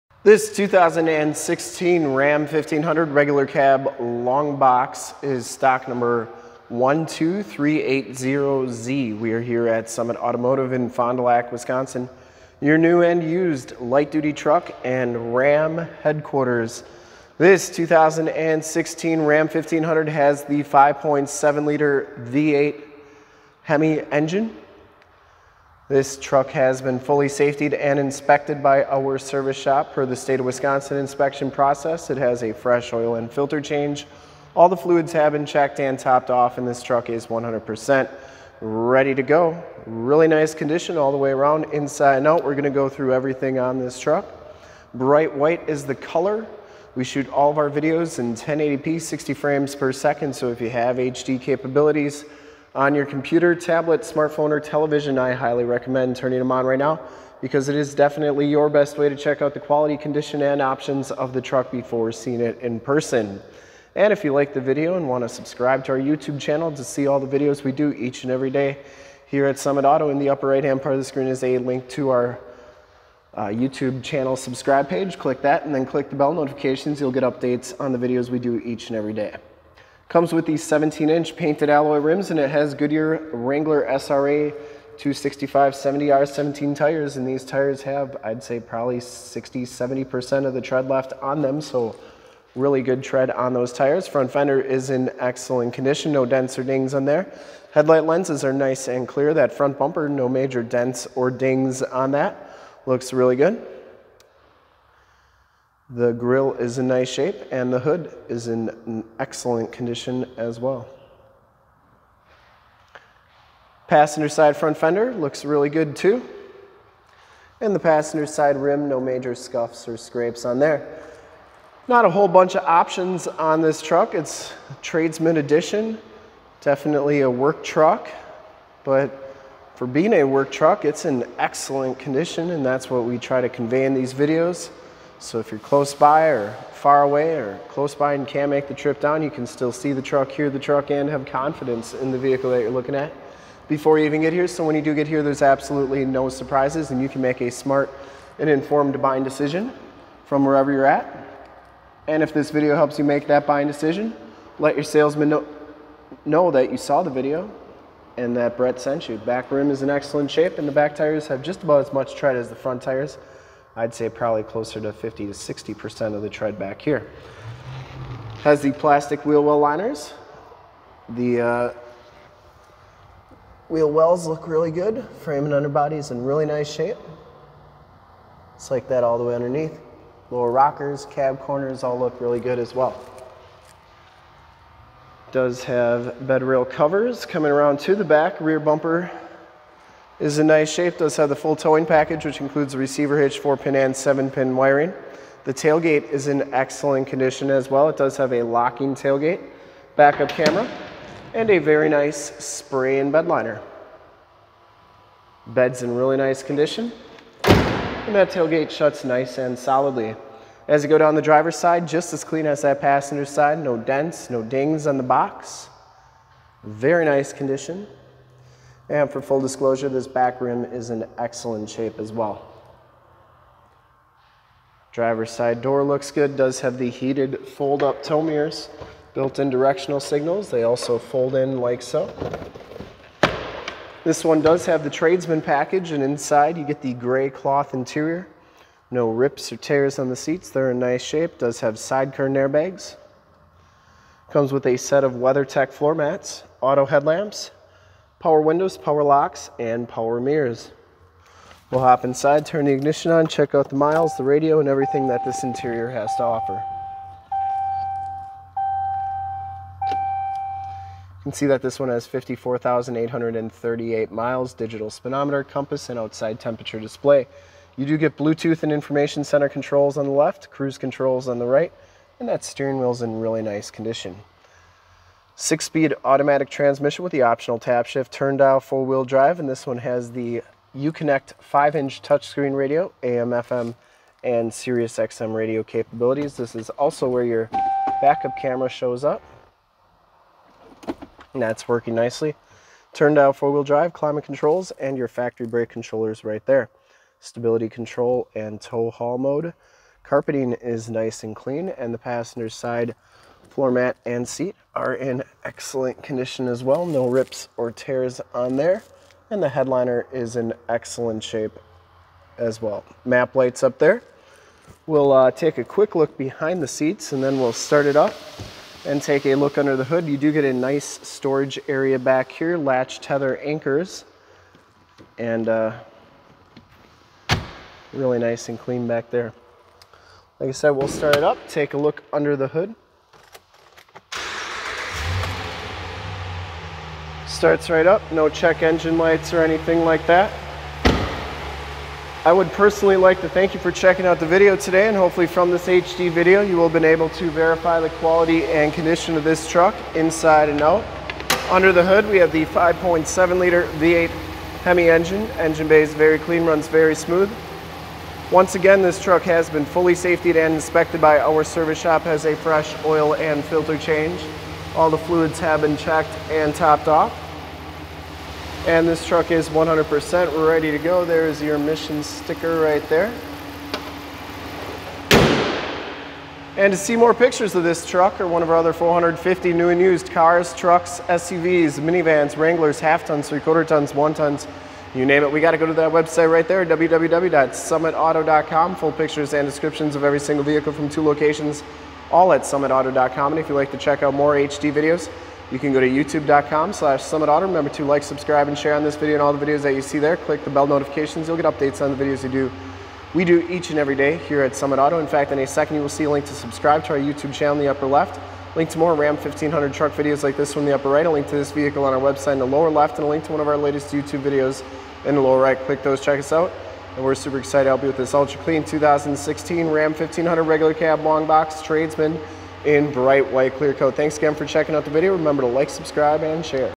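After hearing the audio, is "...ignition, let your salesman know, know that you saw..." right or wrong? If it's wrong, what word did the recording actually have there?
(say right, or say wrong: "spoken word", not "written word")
wrong: "decision", not "ignition".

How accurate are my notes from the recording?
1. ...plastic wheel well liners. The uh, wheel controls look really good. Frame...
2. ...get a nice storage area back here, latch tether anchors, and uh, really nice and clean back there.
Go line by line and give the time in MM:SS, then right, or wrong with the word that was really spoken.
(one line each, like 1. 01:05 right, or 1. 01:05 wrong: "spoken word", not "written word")
1. 02:48 wrong: "wells", not "controls"
2. 05:20 right.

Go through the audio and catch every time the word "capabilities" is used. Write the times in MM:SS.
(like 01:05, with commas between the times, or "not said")
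00:51, 04:45.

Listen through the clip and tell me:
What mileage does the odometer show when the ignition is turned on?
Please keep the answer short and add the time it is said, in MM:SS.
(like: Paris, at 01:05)
54,838, at 04:22.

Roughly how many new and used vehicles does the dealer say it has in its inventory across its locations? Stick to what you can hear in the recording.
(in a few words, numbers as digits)
450.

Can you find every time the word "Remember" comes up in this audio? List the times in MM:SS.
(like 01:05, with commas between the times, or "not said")
06:37, 07:05.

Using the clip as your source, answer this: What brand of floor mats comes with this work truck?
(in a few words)
WeatherTech.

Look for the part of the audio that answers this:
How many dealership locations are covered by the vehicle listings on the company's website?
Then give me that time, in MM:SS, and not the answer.
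06:30.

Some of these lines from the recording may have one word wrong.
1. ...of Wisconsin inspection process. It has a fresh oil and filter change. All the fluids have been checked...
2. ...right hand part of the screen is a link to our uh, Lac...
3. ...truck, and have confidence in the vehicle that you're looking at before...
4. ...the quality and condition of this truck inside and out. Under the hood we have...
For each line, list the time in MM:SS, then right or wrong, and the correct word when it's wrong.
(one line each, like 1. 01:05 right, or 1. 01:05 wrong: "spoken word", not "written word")
1. 00:30 right
2. 01:10 wrong: "YouTube", not "Lac"
3. 02:20 right
4. 05:47 right.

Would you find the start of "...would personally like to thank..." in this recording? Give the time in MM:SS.
05:42.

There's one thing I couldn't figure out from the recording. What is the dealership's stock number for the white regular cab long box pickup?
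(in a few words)
12380Z.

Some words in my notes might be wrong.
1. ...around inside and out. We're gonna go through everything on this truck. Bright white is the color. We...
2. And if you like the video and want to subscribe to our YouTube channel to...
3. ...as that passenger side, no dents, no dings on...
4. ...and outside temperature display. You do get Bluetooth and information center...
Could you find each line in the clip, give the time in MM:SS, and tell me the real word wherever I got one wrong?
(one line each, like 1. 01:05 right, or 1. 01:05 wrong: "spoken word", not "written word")
1. 00:41 right
2. 01:03 right
3. 03:32 right
4. 04:25 right.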